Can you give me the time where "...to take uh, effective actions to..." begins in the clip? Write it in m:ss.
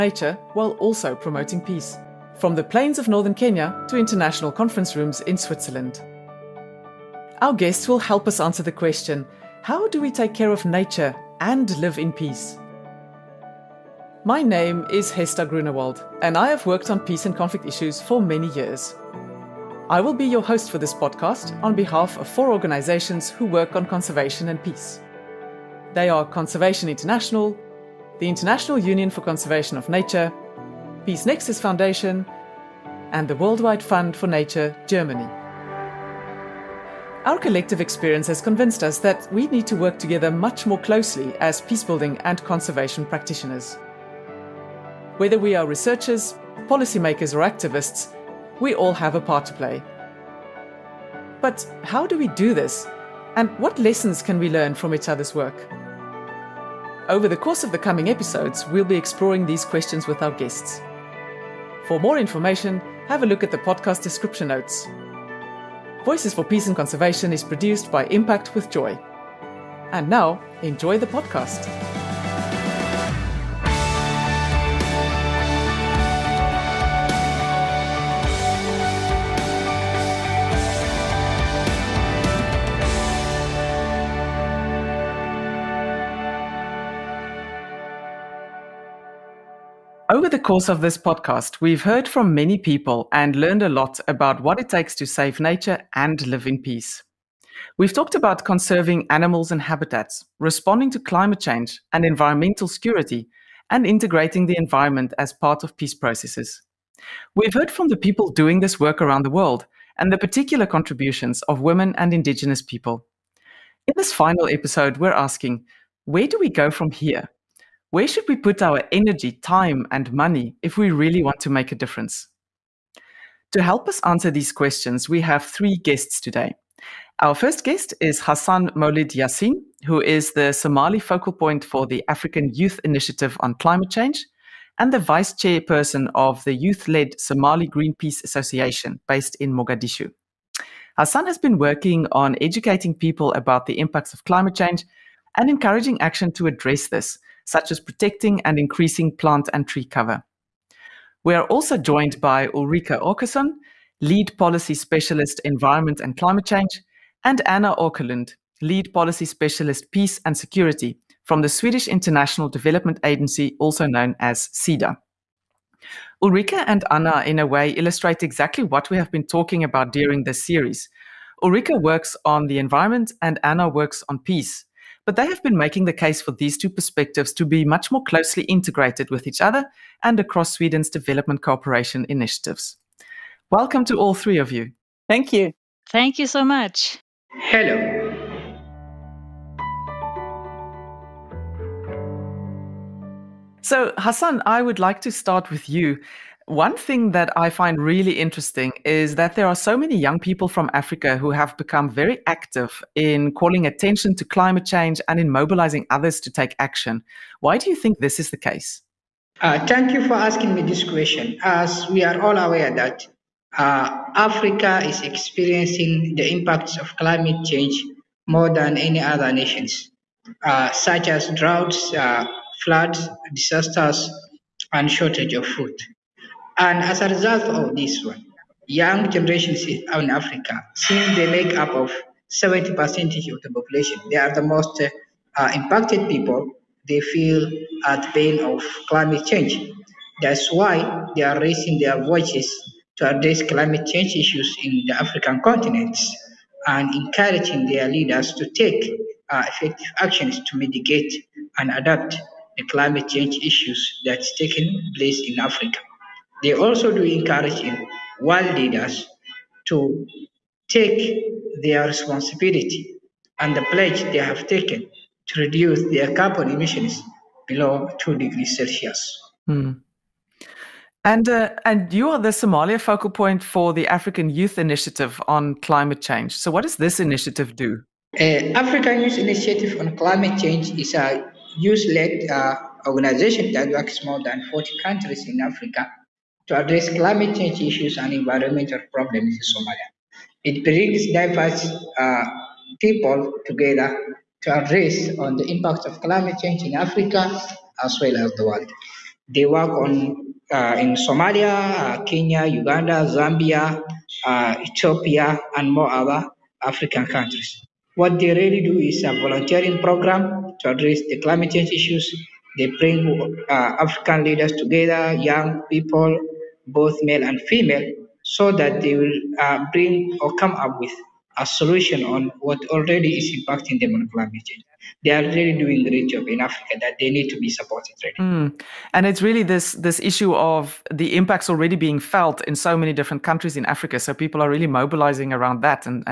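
4:08.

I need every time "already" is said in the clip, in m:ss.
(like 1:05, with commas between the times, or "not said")
5:22, 5:31.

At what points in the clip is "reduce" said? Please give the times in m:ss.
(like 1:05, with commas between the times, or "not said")
4:25.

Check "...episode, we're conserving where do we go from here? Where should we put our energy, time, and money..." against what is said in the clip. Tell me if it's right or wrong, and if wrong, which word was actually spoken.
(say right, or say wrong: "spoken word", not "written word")
wrong: "asking", not "conserving".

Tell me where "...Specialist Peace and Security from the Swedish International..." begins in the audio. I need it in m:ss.
2:39.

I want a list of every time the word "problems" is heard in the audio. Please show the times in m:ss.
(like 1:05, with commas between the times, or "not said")
4:48.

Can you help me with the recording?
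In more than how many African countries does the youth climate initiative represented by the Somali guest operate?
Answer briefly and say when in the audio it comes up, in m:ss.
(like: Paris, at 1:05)
40, at 4:44.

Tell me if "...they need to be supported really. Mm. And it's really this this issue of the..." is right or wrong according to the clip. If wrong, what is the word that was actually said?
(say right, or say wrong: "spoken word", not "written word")
right.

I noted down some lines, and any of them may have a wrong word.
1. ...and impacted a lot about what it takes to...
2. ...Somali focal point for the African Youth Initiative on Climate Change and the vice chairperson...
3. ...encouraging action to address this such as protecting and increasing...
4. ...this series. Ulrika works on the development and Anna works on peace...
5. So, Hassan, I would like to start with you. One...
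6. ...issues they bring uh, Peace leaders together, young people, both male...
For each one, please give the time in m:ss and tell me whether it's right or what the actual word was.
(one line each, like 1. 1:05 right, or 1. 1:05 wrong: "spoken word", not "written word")
1. 1:33 wrong: "learned", not "impacted"
2. 2:10 right
3. 2:25 right
4. 2:50 wrong: "environment", not "development"
5. 3:13 right
6. 5:11 wrong: "African", not "Peace".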